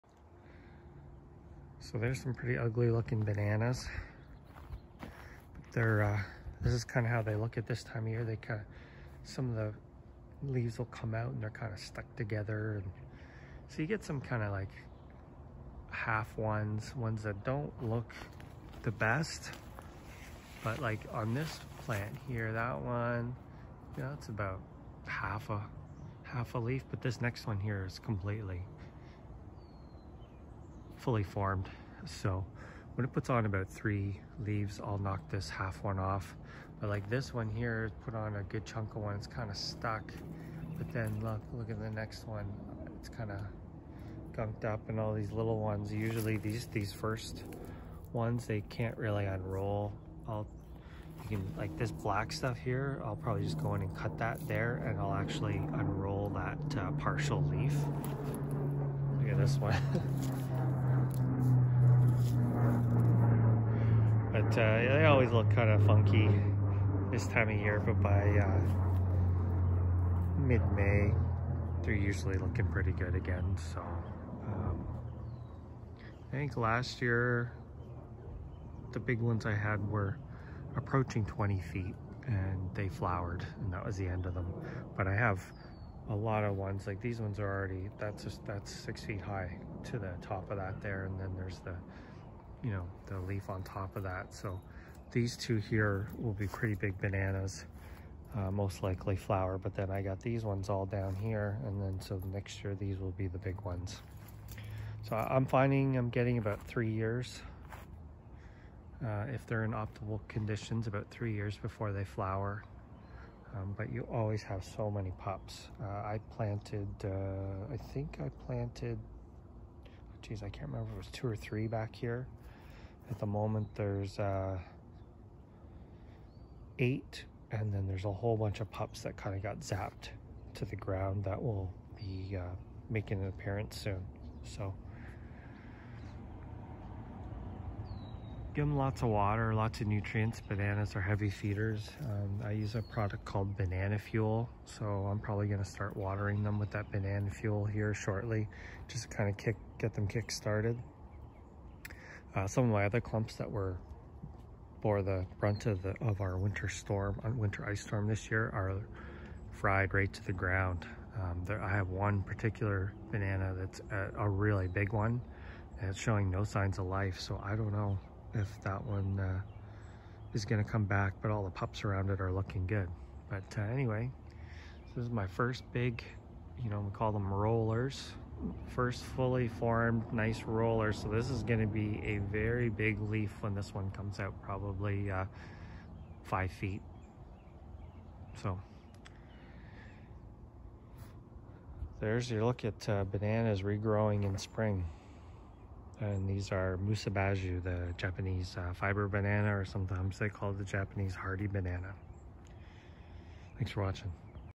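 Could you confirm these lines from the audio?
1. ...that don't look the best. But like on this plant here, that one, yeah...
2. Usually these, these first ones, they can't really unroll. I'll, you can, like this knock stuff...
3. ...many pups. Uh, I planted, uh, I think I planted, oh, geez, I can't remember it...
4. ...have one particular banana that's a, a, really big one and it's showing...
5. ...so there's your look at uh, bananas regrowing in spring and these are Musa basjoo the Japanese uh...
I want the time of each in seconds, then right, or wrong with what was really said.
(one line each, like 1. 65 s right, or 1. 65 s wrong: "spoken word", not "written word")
1. 17 s right
2. 45 s wrong: "black", not "knock"
3. 114 s right
4. 161 s right
5. 188 s right.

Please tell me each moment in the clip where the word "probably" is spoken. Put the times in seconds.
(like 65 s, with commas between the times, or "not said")
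53 s, 145 s, 184 s.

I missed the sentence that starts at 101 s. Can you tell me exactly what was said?
And then so next year, these will be the big ones.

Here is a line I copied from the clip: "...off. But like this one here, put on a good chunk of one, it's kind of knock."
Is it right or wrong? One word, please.
wrong.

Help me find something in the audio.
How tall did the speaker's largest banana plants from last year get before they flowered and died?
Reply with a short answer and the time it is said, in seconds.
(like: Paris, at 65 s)
nearly 20 feet, at 80 s.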